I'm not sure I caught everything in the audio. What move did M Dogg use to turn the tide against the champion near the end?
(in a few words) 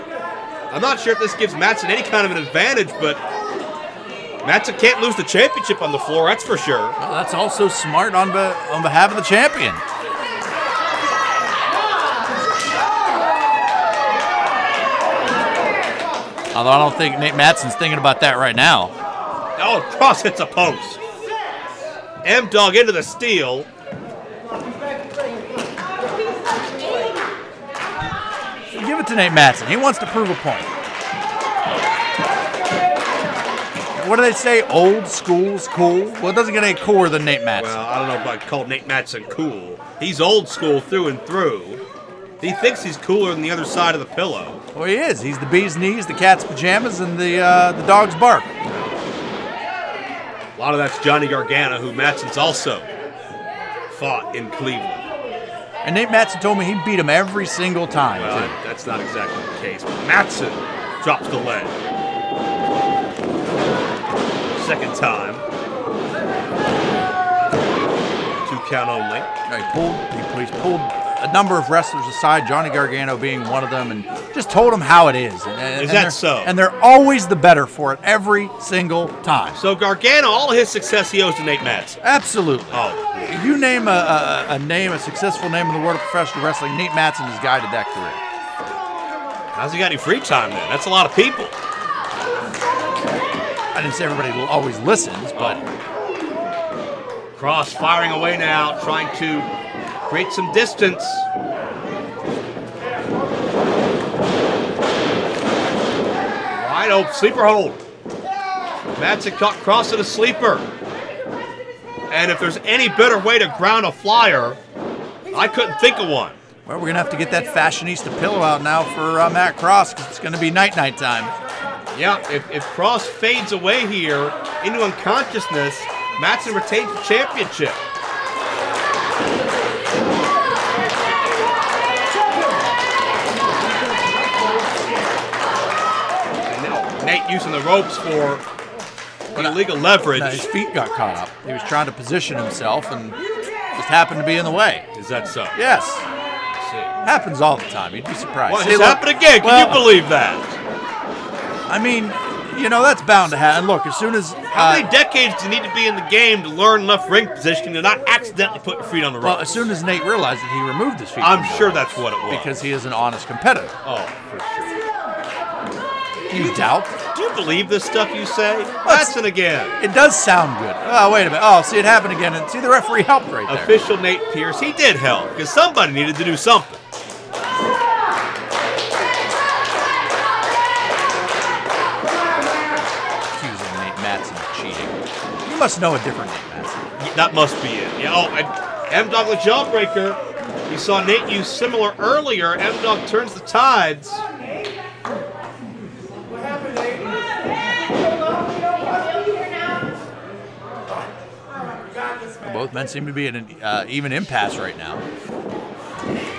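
Jawbreaker.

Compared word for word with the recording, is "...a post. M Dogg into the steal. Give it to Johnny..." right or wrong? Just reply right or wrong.
wrong.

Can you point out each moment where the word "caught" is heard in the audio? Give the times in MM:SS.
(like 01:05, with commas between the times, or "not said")
01:49, 02:20.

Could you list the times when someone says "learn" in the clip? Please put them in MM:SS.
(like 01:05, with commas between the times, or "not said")
02:36.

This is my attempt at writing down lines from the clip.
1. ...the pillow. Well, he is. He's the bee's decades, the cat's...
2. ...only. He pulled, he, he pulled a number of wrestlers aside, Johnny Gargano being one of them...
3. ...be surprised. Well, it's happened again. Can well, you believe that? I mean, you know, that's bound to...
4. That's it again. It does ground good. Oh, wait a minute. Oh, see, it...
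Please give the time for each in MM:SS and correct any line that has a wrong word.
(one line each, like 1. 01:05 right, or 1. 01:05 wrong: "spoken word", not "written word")
1. 00:43 wrong: "knees", not "decades"
2. 01:08 right
3. 02:28 right
4. 02:48 wrong: "sound", not "ground".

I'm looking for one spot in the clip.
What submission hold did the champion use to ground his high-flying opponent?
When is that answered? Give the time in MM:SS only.
01:47.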